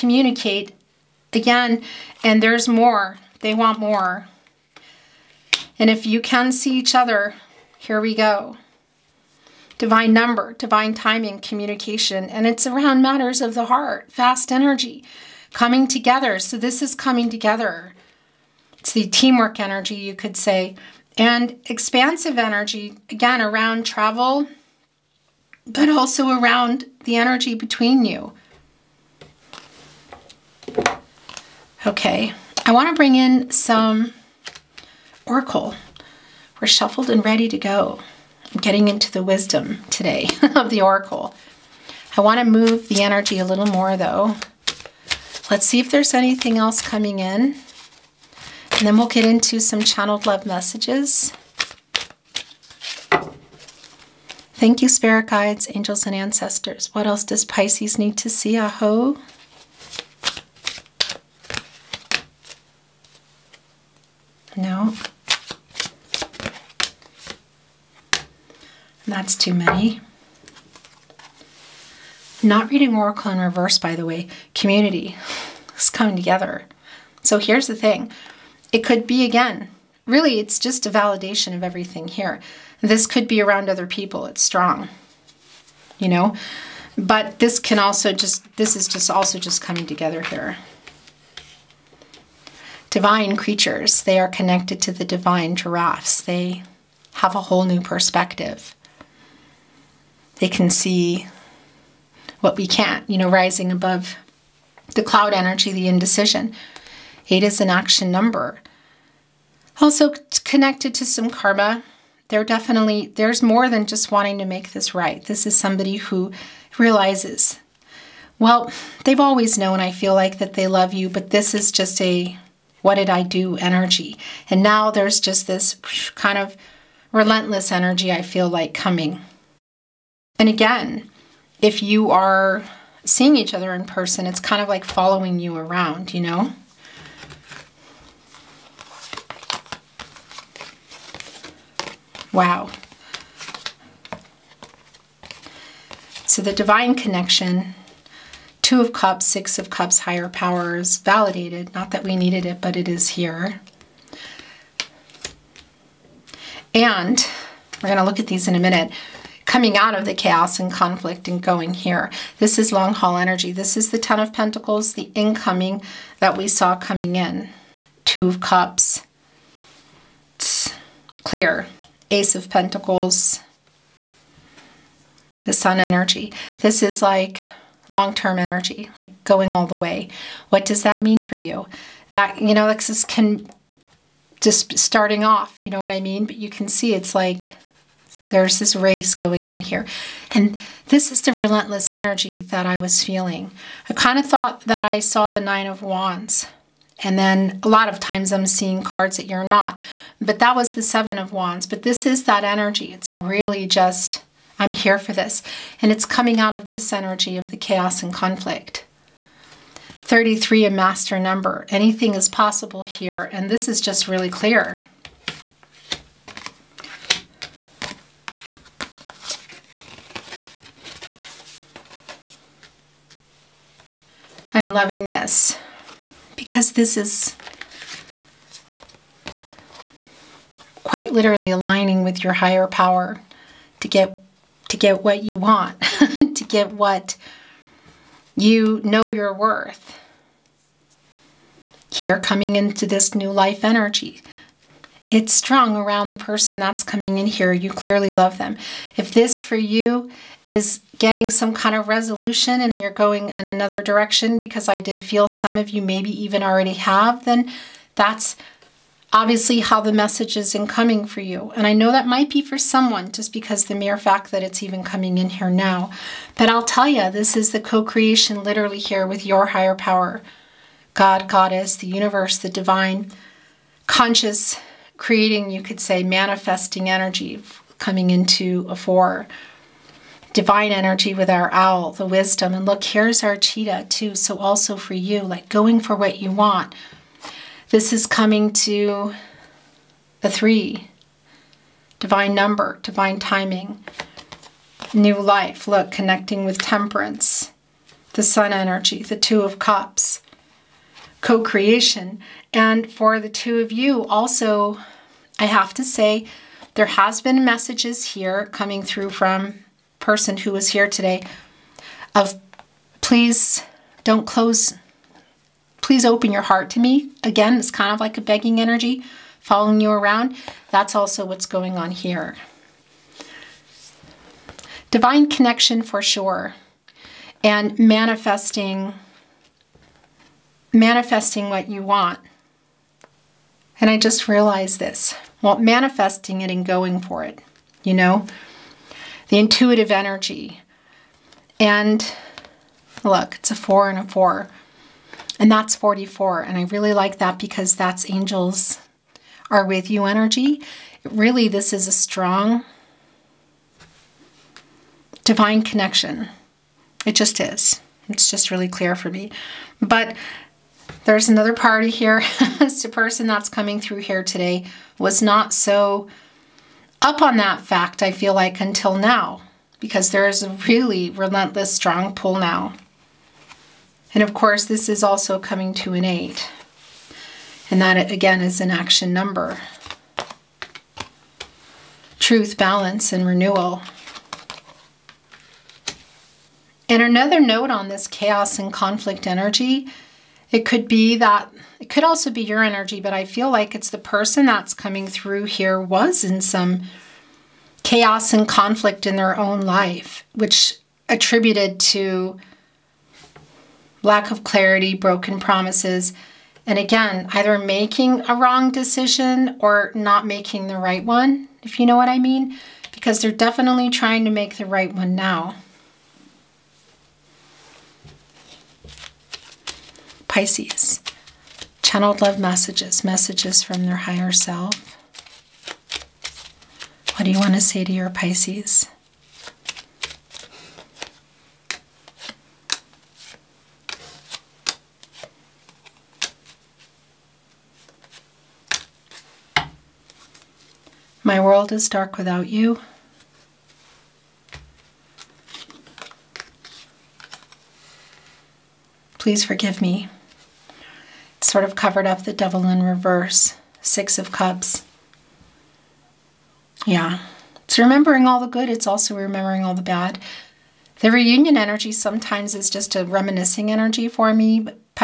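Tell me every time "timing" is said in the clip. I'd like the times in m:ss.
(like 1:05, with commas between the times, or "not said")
0:10, 4:53.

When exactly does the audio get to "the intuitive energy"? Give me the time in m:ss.
5:39.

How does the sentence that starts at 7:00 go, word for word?
Pisces, channeled love messages, messages from their higher self.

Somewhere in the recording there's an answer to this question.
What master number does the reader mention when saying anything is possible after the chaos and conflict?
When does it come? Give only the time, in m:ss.
3:29.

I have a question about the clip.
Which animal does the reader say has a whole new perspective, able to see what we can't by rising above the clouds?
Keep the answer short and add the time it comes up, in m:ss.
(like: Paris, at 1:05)
Giraffes, at 1:35.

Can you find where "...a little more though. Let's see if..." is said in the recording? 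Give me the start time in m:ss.
0:43.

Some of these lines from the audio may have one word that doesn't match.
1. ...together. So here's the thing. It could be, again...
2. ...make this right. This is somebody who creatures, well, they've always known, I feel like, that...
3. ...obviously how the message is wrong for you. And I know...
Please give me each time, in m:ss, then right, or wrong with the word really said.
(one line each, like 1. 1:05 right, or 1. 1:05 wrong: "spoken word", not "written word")
1. 1:16 right
2. 1:54 wrong: "realizes", not "creatures"
3. 4:19 wrong: "incoming", not "wrong".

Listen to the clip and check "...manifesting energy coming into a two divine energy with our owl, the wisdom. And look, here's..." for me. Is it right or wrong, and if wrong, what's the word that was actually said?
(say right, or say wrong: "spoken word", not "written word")
wrong: "four", not "two".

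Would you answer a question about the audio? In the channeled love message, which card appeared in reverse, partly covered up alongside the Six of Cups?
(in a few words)
The Devil.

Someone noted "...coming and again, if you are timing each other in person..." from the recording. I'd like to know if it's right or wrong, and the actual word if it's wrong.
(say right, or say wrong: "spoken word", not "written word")
wrong: "seeing", not "timing".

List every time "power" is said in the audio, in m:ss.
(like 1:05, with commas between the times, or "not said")
2:30, 3:52, 4:29.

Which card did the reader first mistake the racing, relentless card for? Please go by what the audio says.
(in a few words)
Nine of Wands.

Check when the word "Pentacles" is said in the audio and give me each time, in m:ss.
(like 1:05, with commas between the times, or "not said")
2:44, 2:52.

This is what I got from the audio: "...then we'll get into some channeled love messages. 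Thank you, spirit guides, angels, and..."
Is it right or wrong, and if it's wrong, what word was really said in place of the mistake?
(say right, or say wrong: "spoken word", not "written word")
right.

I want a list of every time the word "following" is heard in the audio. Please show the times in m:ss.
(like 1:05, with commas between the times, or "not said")
2:14, 5:19.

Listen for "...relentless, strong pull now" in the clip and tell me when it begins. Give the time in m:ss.
6:11.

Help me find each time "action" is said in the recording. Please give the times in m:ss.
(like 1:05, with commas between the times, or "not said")
1:47, 6:18.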